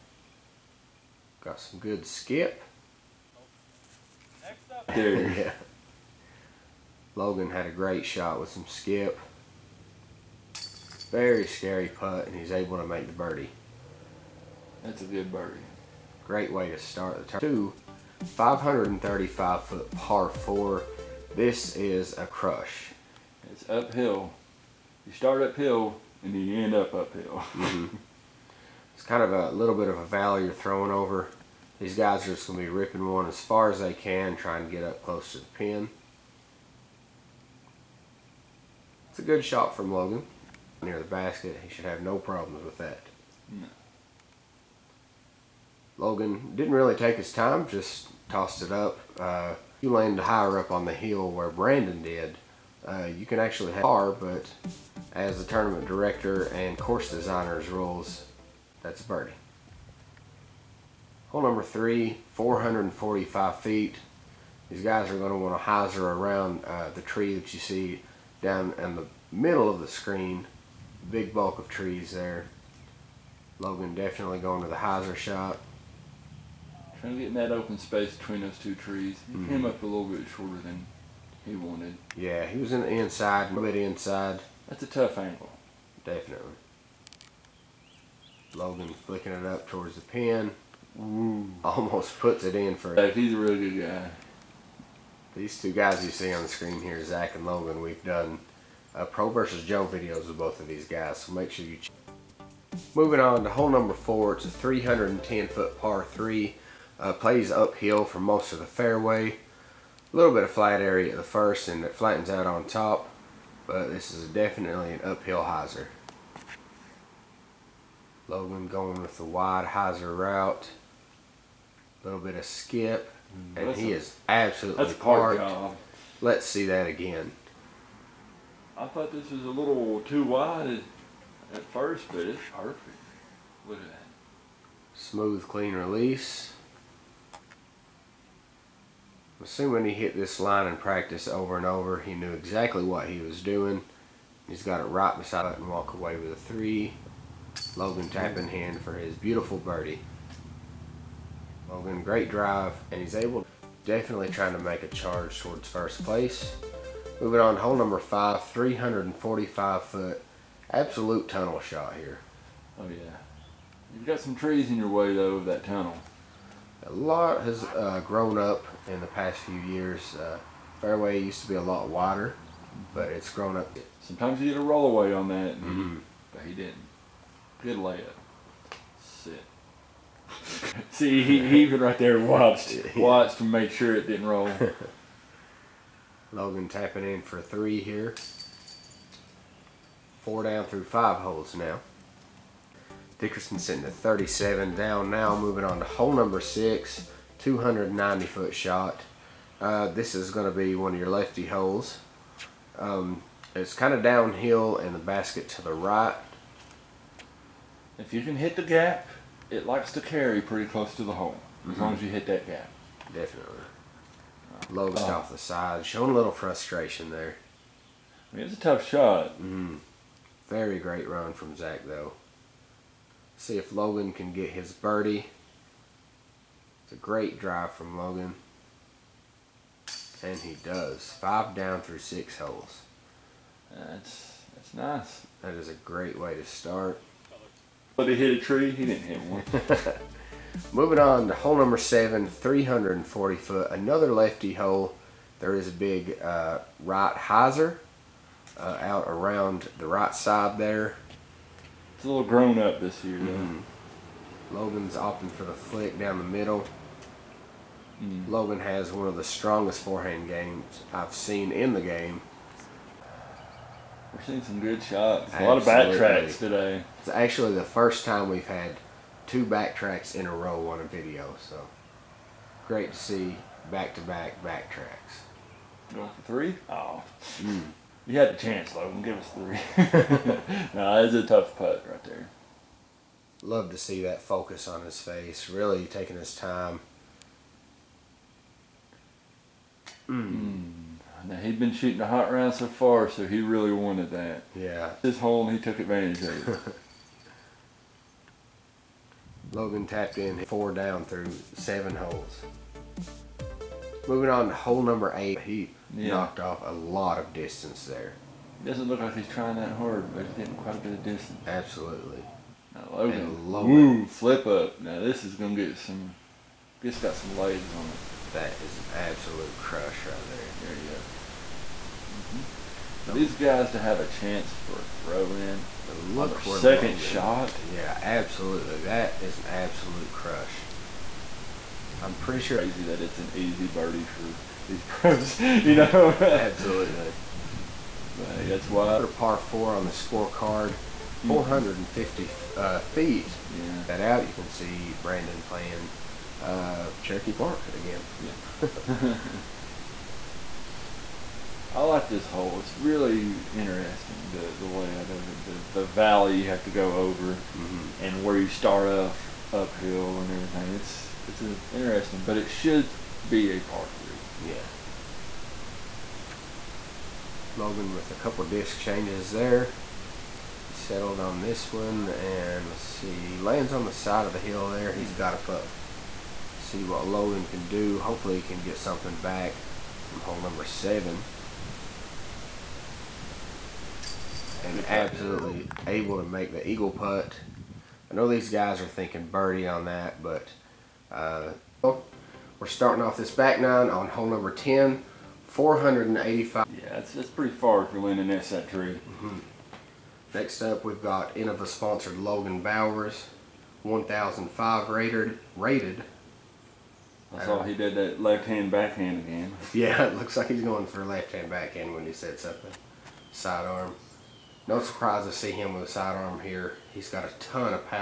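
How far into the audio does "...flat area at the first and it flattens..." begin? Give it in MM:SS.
01:50.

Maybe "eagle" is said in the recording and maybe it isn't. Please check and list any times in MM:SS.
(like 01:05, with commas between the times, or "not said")
06:26.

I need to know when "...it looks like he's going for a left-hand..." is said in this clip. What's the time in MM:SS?
06:50.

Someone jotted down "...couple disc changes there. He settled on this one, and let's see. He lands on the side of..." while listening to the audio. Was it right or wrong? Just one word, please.
right.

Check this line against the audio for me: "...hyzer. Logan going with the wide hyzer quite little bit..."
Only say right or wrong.
wrong.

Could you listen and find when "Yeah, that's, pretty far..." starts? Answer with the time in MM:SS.
06:36.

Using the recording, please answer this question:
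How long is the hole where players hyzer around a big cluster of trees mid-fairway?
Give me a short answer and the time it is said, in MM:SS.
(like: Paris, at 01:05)
445 feet, at 01:02.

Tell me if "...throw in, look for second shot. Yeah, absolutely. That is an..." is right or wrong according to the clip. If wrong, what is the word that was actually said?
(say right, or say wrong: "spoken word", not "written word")
right.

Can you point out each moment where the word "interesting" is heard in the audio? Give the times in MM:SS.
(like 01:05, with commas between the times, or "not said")
05:53, 06:01.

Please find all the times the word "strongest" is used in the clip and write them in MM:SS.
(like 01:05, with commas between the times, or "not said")
04:19.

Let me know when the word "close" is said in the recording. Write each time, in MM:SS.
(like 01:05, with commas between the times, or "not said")
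00:35, 03:30.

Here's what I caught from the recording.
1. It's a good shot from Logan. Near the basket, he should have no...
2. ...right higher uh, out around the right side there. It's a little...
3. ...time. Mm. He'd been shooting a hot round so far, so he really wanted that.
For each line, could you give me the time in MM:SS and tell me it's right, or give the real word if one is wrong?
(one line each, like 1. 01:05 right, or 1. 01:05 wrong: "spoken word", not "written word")
1. 00:39 right
2. 04:06 wrong: "hyzer", not "higher"
3. 04:46 right.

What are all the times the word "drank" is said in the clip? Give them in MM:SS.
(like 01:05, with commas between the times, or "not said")
not said.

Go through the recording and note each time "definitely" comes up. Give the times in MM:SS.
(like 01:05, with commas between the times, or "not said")
01:13, 01:26, 01:54, 02:33, 03:33.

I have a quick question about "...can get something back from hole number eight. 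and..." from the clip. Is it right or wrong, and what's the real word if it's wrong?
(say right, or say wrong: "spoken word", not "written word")
wrong: "seven", not "eight".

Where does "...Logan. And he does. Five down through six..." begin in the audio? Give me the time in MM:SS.
03:47.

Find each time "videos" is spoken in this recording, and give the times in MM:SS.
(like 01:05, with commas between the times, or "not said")
01:39, 04:30.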